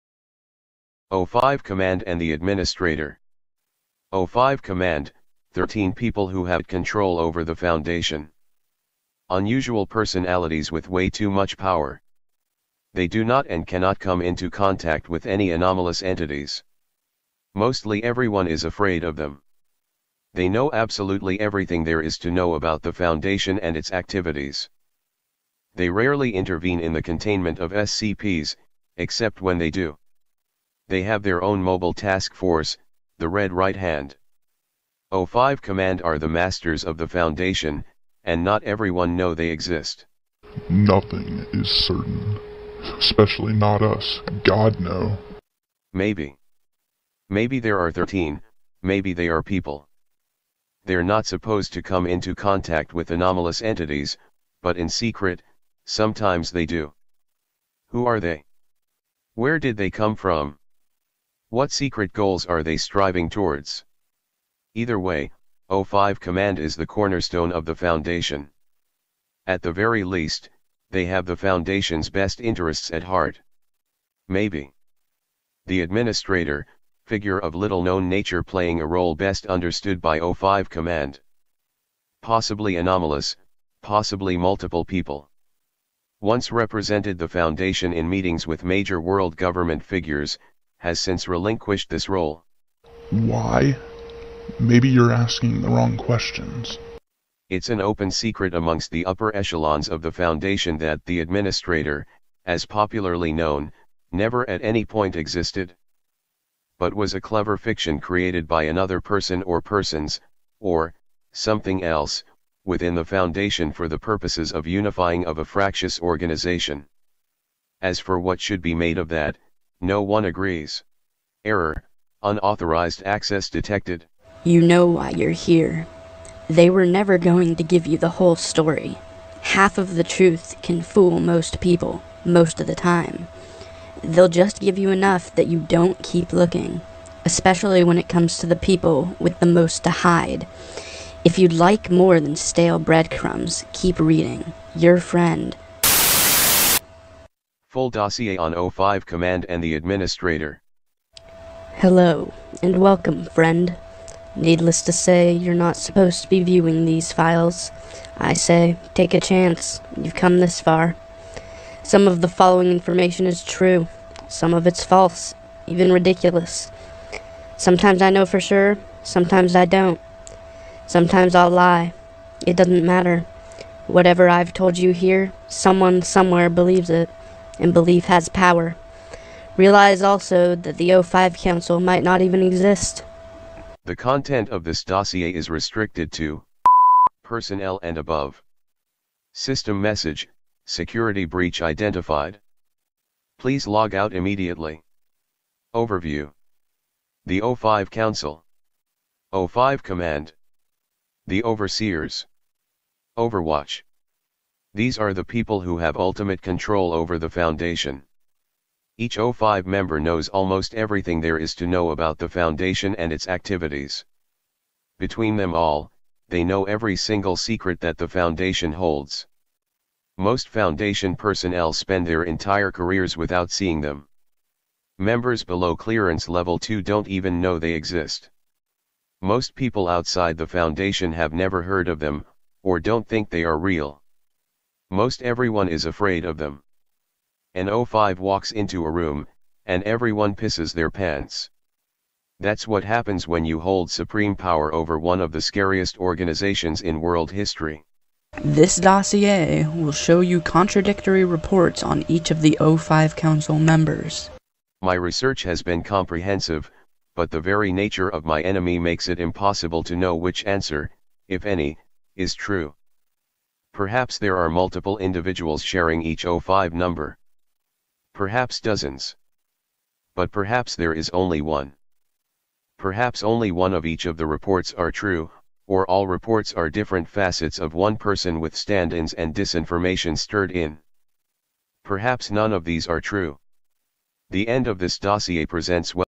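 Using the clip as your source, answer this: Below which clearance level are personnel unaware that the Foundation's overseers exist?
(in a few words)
Level 2.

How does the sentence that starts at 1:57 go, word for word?
As for what should be made of that, no one agrees.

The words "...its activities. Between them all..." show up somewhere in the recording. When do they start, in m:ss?
3:33.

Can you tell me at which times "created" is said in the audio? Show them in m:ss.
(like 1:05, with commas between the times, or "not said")
1:47.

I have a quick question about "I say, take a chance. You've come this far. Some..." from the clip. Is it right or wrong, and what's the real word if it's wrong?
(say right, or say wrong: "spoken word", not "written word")
right.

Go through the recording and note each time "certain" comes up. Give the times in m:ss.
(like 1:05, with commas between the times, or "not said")
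0:41.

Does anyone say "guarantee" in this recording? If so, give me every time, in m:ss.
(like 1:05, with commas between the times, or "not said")
not said.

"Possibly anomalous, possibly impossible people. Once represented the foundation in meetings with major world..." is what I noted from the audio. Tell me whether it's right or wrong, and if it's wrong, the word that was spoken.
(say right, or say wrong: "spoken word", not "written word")
wrong: "multiple", not "impossible".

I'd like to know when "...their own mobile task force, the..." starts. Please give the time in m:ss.
0:31.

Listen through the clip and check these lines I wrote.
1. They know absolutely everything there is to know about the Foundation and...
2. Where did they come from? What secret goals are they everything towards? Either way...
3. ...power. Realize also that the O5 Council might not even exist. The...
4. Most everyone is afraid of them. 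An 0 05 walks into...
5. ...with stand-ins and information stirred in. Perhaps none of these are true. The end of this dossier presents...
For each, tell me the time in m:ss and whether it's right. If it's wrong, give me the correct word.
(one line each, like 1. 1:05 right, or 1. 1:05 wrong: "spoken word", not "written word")
1. 0:20 right
2. 0:59 wrong: "striving", not "everything"
3. 2:58 right
4. 3:54 right
5. 4:38 wrong: "disinformation", not "information".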